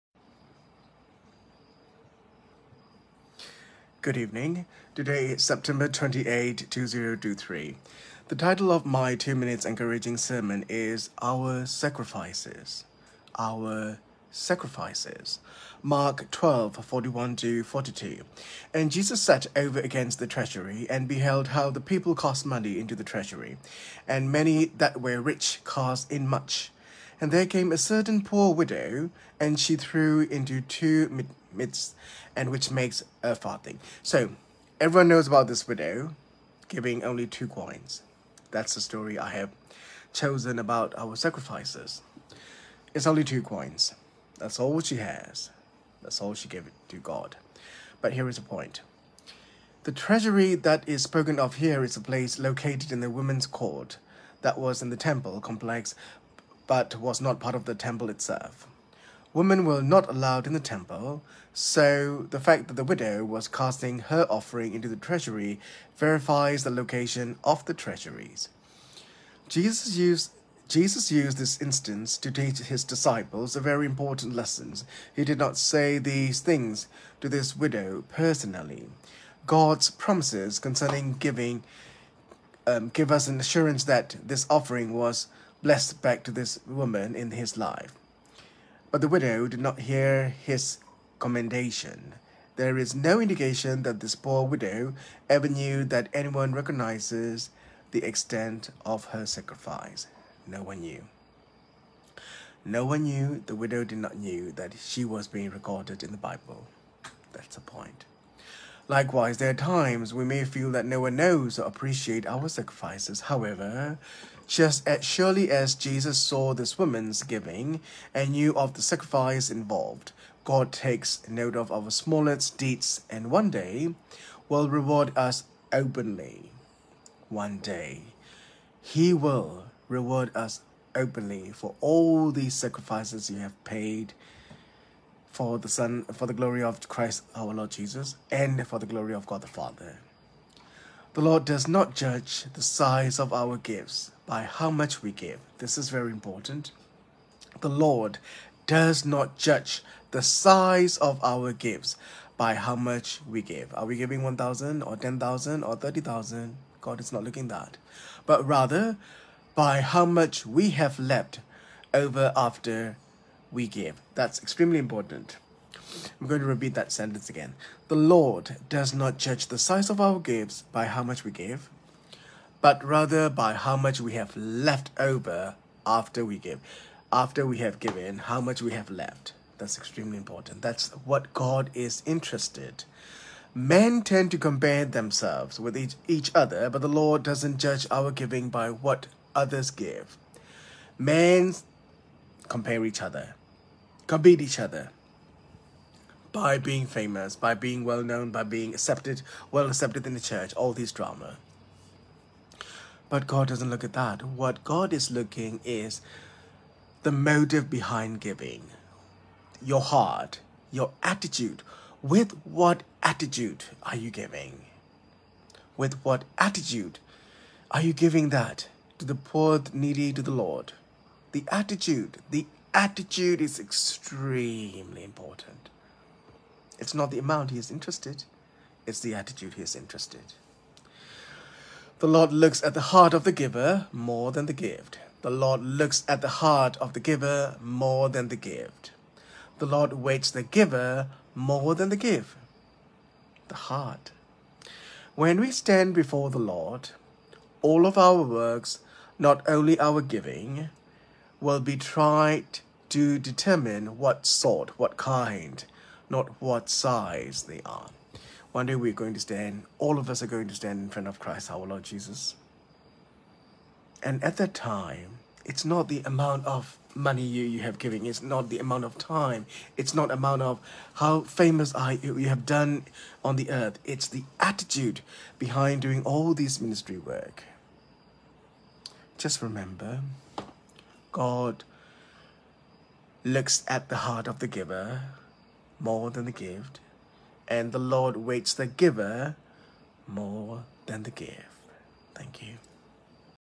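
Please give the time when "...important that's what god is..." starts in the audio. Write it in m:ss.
3:00.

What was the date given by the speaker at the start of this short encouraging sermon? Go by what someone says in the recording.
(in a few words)
September 28, 2023.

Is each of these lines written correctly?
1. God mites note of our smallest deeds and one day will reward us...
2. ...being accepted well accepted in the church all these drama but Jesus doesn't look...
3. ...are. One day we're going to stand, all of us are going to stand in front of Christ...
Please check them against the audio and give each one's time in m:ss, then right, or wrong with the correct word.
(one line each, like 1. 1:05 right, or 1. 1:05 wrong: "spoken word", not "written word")
1. 2:00 wrong: "takes", not "mites"
2. 3:18 wrong: "God", not "Jesus"
3. 4:17 right.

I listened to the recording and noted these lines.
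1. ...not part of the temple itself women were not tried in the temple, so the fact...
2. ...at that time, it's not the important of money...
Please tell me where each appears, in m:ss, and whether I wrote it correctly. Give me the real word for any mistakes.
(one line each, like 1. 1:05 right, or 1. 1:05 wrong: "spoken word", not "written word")
1. 0:57 wrong: "allowed", not "tried"
2. 4:24 wrong: "amount", not "important".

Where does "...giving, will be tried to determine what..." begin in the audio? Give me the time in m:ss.
4:10.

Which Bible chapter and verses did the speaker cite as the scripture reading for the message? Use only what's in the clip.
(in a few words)
Mark 12:41-42.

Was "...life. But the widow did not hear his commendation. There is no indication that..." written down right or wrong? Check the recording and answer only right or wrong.
right.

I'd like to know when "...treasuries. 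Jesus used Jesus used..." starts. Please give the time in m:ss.
1:07.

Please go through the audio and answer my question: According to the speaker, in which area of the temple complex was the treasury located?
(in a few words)
the women's court.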